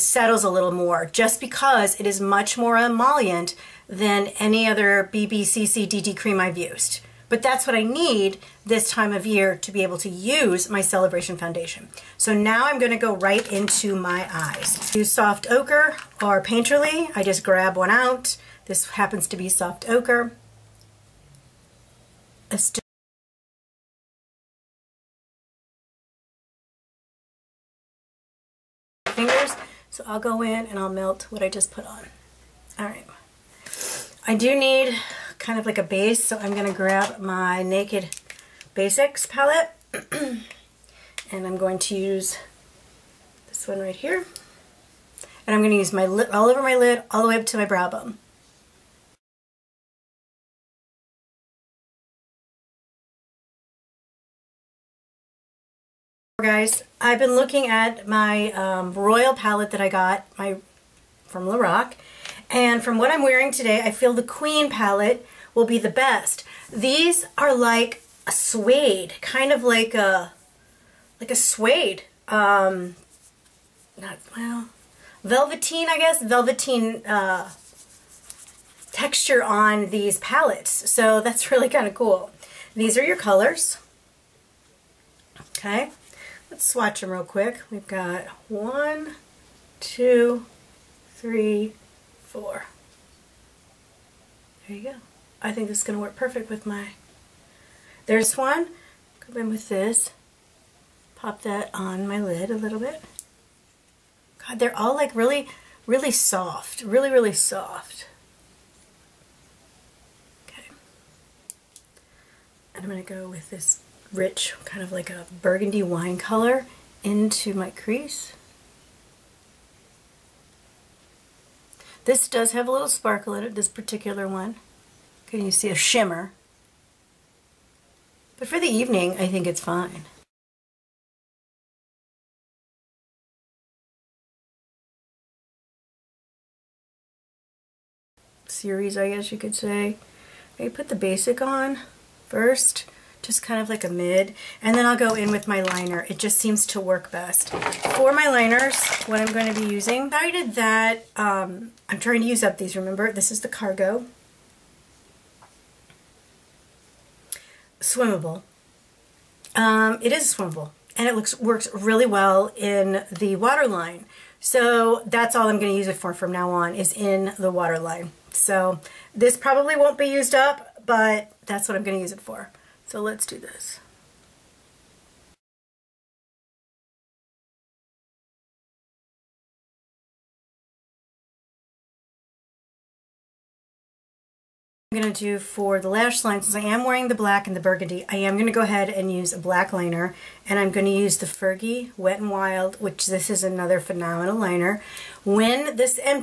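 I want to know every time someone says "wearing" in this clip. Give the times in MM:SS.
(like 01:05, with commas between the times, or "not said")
01:03, 03:06.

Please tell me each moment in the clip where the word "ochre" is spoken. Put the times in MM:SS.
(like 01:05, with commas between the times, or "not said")
00:15, 00:19.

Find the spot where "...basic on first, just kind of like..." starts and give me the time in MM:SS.
02:20.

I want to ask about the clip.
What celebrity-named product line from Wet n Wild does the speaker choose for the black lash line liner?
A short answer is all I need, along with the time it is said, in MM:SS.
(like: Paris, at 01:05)
Fergie, at 03:11.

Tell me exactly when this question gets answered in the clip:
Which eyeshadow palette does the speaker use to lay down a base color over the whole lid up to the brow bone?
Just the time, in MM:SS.
00:37.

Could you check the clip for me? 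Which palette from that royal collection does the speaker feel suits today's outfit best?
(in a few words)
queen palette.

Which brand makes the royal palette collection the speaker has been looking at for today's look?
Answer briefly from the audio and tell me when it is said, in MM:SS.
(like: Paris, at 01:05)
Lorac, at 01:01.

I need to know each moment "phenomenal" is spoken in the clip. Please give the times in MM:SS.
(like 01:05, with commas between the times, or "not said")
03:13.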